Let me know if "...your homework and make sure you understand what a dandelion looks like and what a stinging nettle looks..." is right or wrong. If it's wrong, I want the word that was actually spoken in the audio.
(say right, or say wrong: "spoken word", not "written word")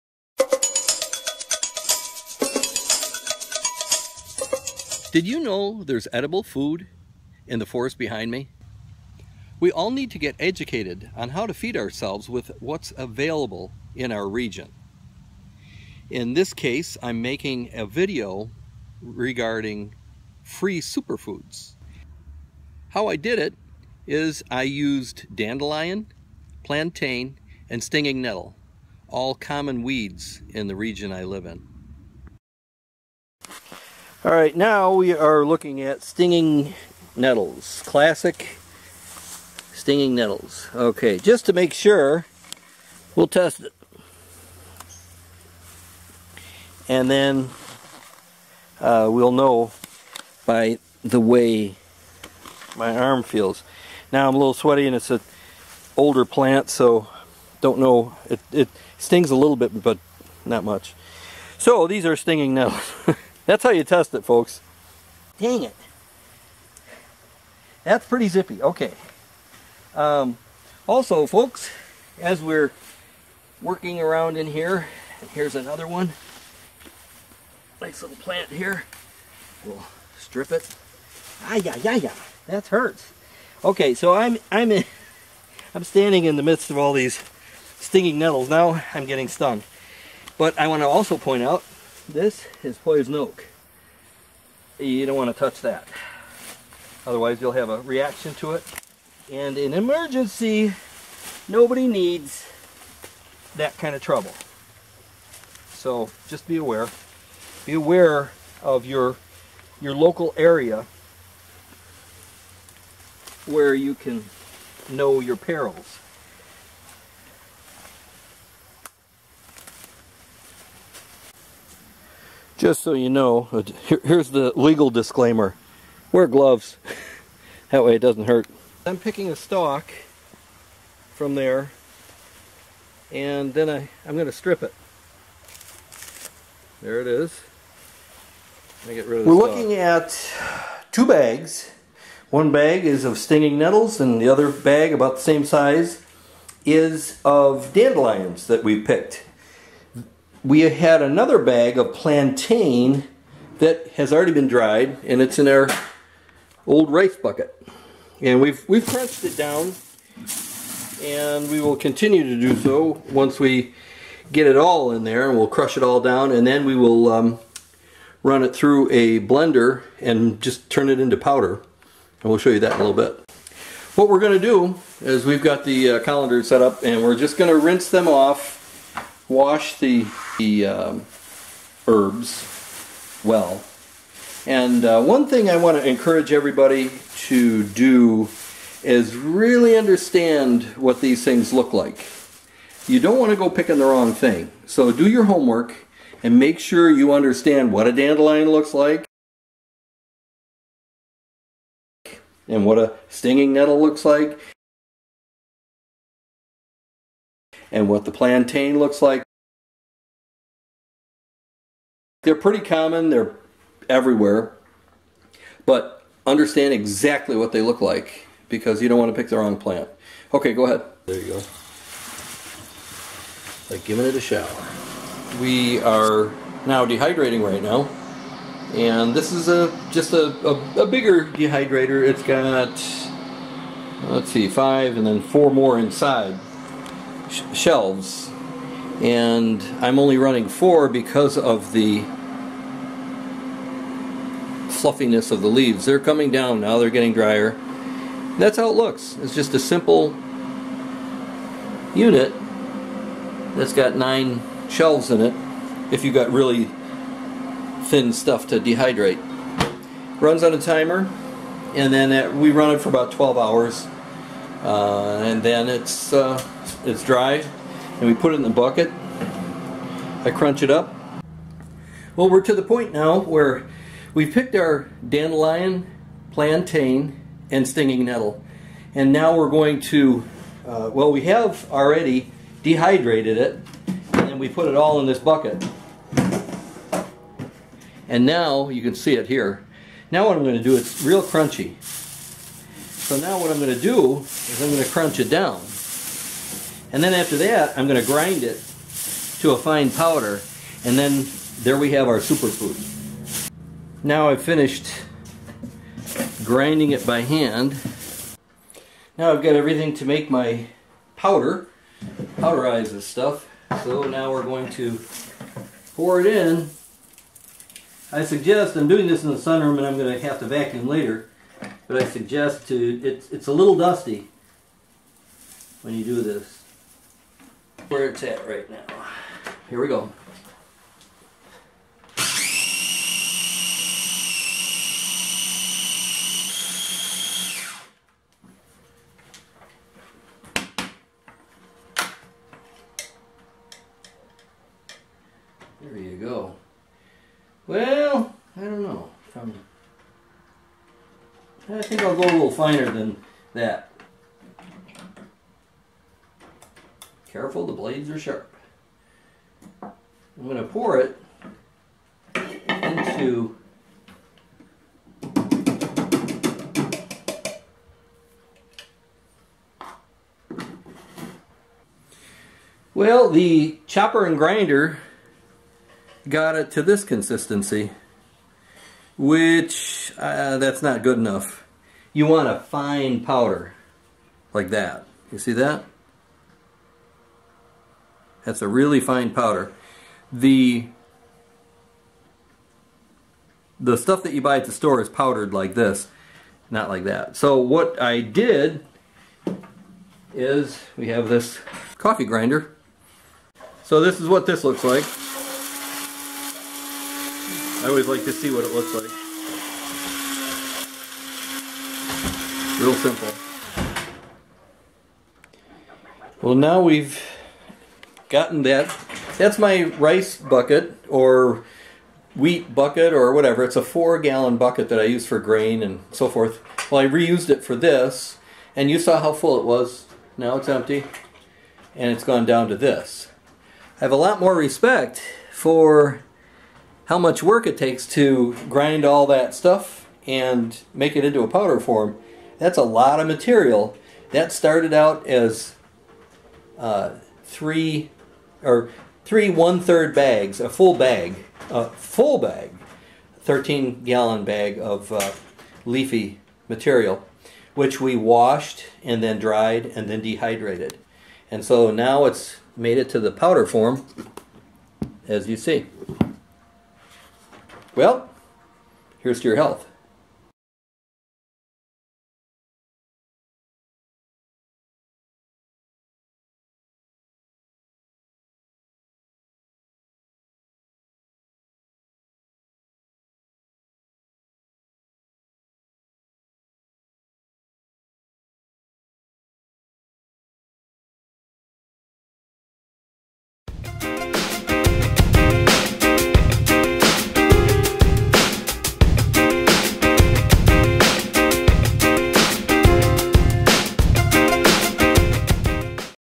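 right.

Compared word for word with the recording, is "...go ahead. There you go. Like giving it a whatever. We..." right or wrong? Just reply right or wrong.
wrong.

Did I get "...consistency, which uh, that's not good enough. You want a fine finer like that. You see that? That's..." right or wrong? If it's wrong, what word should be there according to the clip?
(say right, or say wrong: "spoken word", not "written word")
wrong: "powder", not "finer".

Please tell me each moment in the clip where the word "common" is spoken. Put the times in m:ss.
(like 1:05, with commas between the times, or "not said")
0:29, 3:32.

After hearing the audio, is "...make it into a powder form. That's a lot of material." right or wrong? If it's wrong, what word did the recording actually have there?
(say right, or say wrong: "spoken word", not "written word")
right.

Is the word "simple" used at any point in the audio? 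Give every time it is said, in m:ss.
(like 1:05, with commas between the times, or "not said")
4:09, 6:52.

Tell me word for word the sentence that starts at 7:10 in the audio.
Now it's empty and it's gone down to this.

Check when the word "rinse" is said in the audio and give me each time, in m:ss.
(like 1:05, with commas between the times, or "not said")
2:57.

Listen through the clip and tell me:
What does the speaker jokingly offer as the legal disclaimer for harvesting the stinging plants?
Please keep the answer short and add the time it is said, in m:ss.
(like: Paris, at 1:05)
Wear gloves, at 2:06.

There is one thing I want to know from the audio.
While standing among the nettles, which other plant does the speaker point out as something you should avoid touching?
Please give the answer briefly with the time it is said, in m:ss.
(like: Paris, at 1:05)
Poison oak, at 1:32.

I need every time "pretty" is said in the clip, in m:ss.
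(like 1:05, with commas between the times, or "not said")
1:08, 3:32.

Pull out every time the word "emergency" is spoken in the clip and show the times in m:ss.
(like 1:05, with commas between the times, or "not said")
1:39.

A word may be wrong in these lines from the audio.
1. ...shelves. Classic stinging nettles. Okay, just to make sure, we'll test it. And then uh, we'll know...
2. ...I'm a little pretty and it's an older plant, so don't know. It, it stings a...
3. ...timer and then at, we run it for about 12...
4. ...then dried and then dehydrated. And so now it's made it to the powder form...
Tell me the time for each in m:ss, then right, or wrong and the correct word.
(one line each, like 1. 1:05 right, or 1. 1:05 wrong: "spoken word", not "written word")
1. 0:37 wrong: "nettles", not "shelves"
2. 0:54 wrong: "sweaty", not "pretty"
3. 4:20 right
4. 7:39 right.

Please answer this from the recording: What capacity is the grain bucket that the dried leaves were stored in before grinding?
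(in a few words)
4 gallons.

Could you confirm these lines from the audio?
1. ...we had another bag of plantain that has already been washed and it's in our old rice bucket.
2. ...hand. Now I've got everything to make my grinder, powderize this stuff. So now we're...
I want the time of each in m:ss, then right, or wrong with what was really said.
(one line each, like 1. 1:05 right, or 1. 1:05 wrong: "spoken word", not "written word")
1. 2:30 wrong: "dried", not "washed"
2. 5:07 wrong: "powder", not "grinder".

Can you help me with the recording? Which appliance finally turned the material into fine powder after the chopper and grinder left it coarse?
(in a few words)
Coffee grinder.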